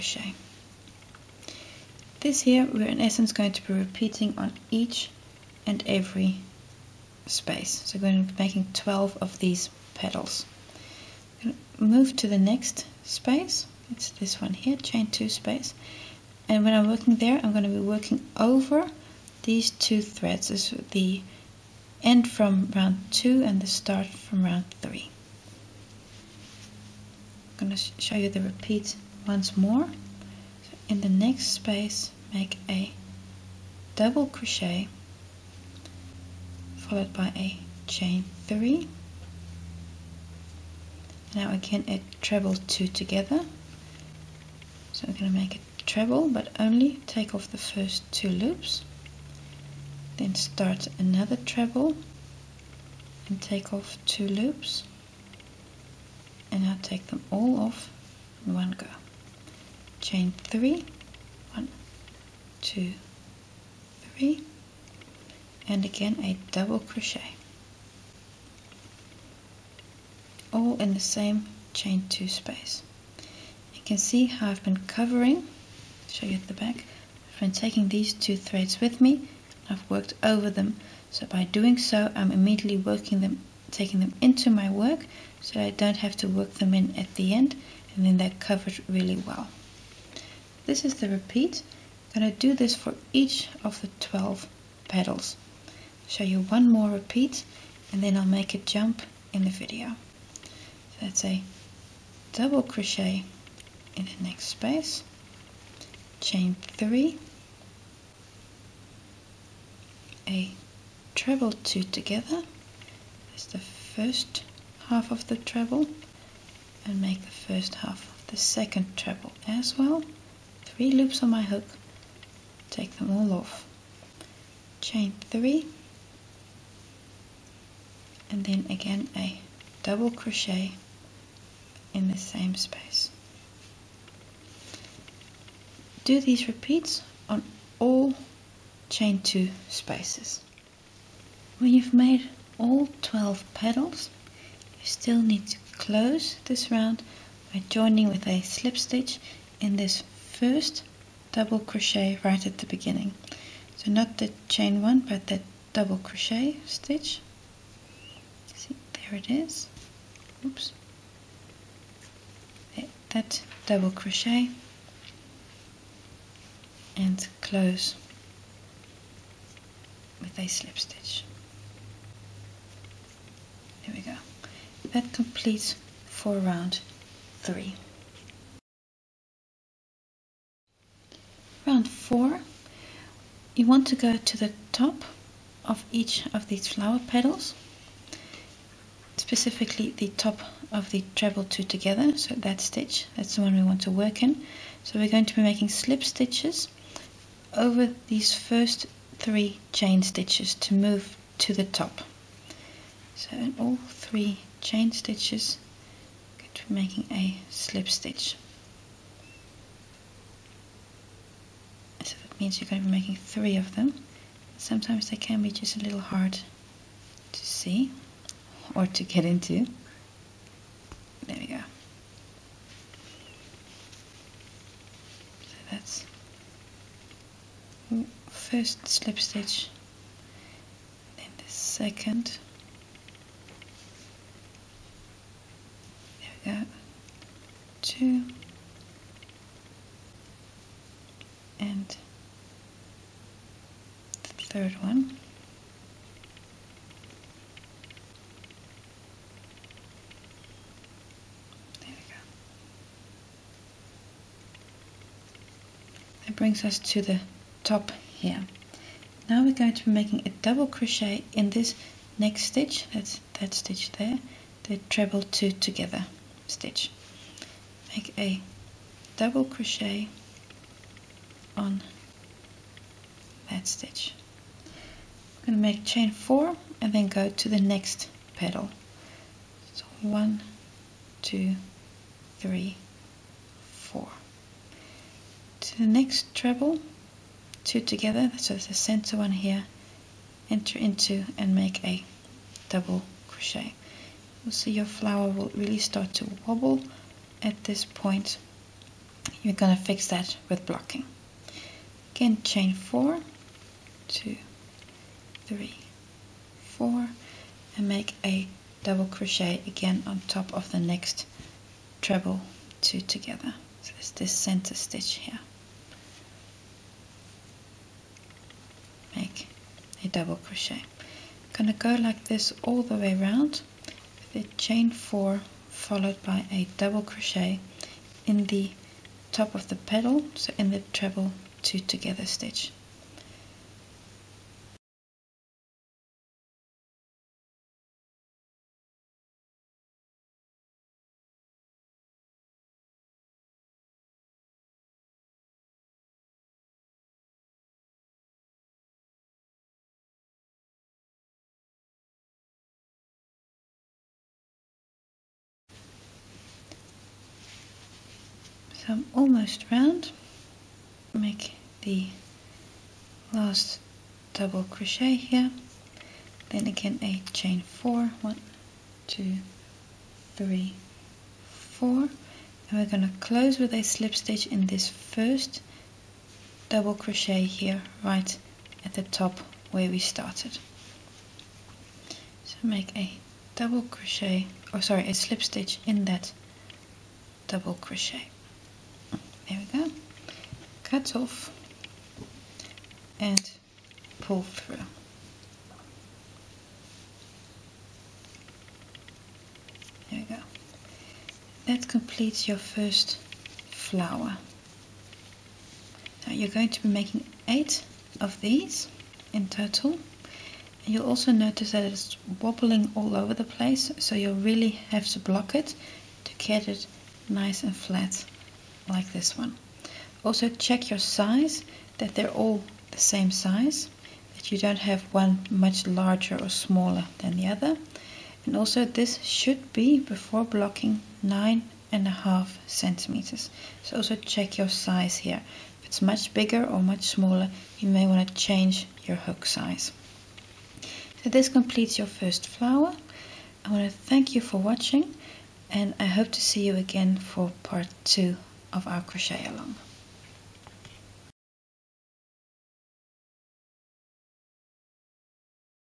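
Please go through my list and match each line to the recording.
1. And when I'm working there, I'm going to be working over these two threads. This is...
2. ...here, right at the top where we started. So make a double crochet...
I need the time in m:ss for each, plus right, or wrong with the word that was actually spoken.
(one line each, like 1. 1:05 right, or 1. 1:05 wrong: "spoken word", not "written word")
1. 0:16 right
2. 6:17 right.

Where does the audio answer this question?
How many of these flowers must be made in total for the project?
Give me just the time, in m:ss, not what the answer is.
6:47.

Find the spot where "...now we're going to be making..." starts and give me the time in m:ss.
4:19.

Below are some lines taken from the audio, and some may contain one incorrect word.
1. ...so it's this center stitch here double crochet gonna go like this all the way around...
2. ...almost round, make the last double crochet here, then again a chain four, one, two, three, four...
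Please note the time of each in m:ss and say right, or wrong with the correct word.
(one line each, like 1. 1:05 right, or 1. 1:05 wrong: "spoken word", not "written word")
1. 5:13 right
2. 5:59 right.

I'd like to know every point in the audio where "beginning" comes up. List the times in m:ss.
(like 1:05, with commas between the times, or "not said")
2:32.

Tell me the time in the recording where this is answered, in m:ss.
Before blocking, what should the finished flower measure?
7:11.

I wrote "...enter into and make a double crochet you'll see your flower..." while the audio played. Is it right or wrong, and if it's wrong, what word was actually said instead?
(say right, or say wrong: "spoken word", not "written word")
right.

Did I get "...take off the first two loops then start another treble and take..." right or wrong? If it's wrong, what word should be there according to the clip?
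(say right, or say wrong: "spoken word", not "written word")
right.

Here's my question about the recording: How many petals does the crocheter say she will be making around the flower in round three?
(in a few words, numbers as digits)
12.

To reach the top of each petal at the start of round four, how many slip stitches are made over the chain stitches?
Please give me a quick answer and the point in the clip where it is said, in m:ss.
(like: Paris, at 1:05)
3, at 3:32.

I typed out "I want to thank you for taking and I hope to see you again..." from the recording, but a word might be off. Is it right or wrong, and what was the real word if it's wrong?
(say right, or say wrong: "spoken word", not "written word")
wrong: "watching", not "taking".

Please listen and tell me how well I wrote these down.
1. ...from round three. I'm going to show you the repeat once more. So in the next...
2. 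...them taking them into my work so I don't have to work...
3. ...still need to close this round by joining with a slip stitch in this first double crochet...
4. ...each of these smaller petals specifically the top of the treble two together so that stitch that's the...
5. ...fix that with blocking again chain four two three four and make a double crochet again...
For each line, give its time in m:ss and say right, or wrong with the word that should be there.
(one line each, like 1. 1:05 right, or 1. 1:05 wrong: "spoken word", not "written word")
1. 0:24 right
2. 1:23 right
3. 2:24 right
4. 3:05 wrong: "flower", not "smaller"
5. 4:59 right.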